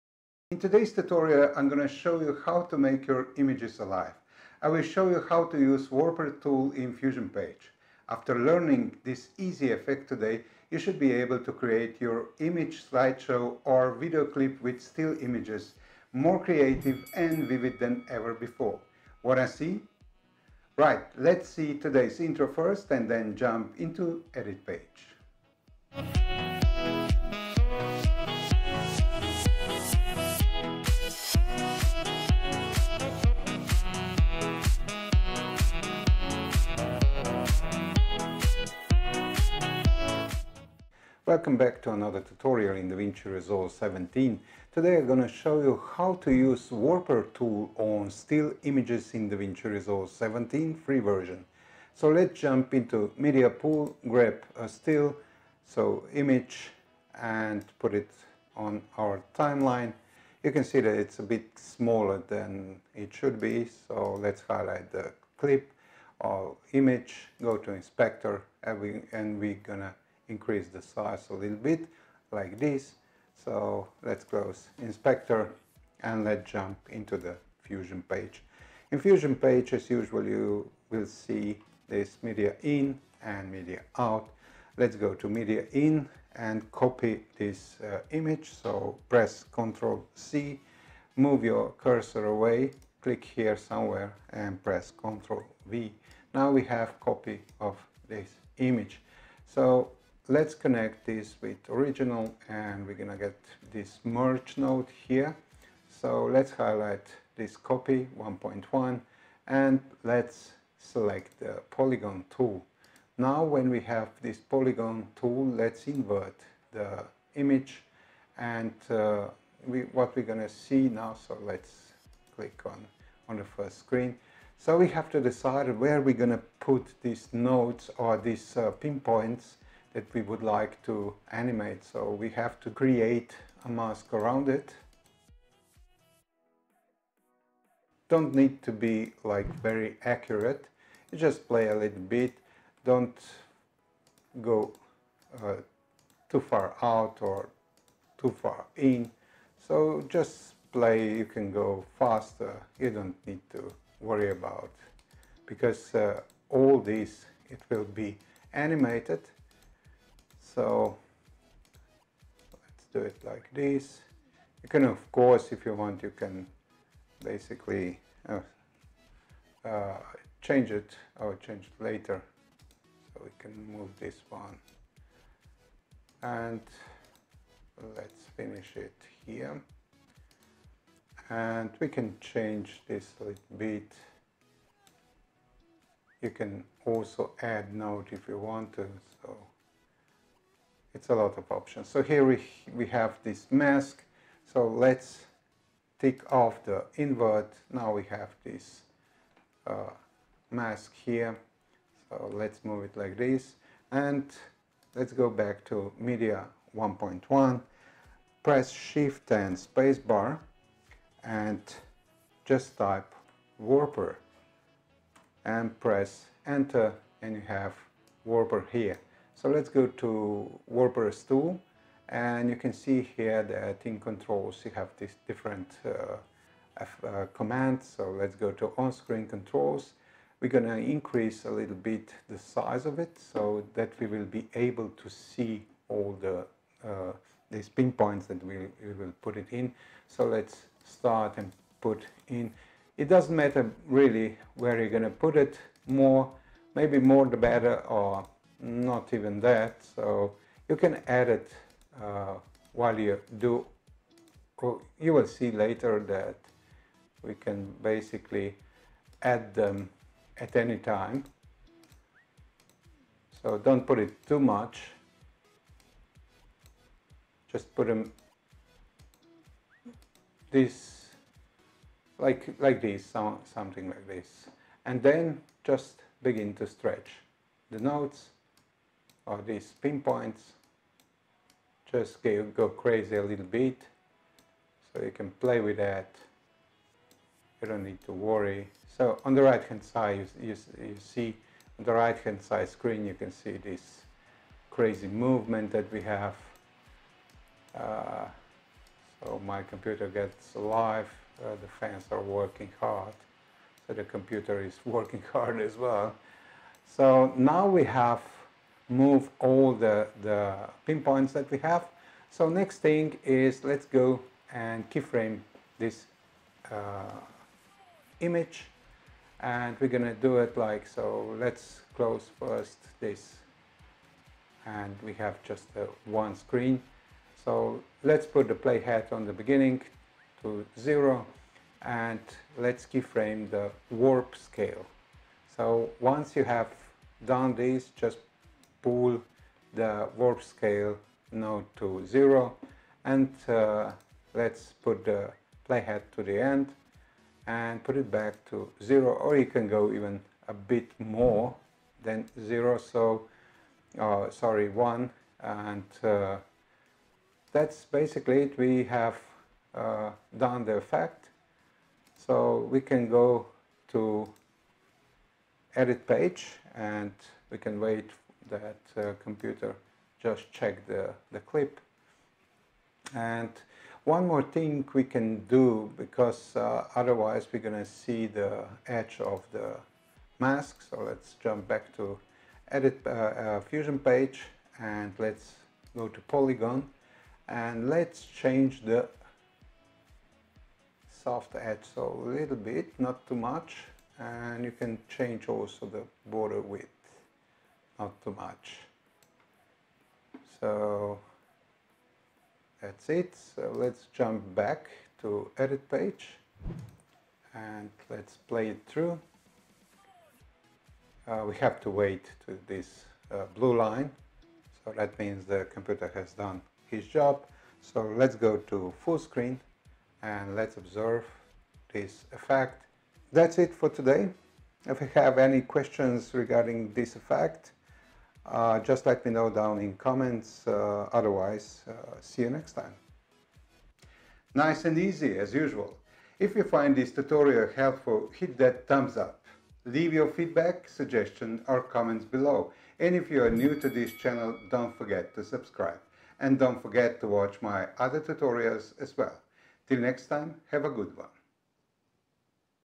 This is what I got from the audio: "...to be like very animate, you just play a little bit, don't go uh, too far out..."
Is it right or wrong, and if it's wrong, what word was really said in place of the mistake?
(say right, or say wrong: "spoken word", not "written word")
wrong: "accurate", not "animate".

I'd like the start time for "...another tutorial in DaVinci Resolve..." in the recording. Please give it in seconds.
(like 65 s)
41 s.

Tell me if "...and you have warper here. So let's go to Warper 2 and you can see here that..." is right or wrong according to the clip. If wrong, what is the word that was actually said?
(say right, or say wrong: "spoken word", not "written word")
right.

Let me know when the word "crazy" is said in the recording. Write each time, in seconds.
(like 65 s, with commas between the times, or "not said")
282 s, 294 s.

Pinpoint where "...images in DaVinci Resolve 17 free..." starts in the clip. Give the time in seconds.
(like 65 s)
48 s.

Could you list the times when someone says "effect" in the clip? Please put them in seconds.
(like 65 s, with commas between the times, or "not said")
9 s, 360 s, 422 s, 427 s.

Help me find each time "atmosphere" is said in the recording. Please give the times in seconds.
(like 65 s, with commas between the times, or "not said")
not said.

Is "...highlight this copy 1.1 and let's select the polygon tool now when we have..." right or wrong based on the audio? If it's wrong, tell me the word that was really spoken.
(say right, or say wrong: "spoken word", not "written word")
right.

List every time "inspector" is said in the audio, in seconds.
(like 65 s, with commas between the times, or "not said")
67 s, 74 s.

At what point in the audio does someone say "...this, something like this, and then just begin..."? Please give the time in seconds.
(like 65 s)
272 s.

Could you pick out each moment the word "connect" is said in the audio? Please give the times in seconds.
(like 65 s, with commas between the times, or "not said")
100 s.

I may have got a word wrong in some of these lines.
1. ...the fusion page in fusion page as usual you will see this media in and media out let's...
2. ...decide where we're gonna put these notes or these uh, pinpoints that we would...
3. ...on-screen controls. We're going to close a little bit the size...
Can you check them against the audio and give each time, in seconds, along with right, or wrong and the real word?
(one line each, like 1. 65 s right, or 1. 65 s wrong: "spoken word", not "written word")
1. 77 s right
2. 125 s wrong: "nodes", not "notes"
3. 228 s wrong: "increase", not "close".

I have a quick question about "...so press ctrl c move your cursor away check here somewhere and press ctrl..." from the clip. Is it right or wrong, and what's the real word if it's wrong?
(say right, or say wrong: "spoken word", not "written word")
wrong: "click", not "check".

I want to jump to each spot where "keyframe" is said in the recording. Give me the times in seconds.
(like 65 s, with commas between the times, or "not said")
314 s, 332 s.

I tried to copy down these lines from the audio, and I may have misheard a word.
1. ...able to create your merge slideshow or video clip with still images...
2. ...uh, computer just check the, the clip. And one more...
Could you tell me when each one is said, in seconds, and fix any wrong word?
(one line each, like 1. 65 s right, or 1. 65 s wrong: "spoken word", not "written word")
1. 11 s wrong: "image", not "merge"
2. 368 s right.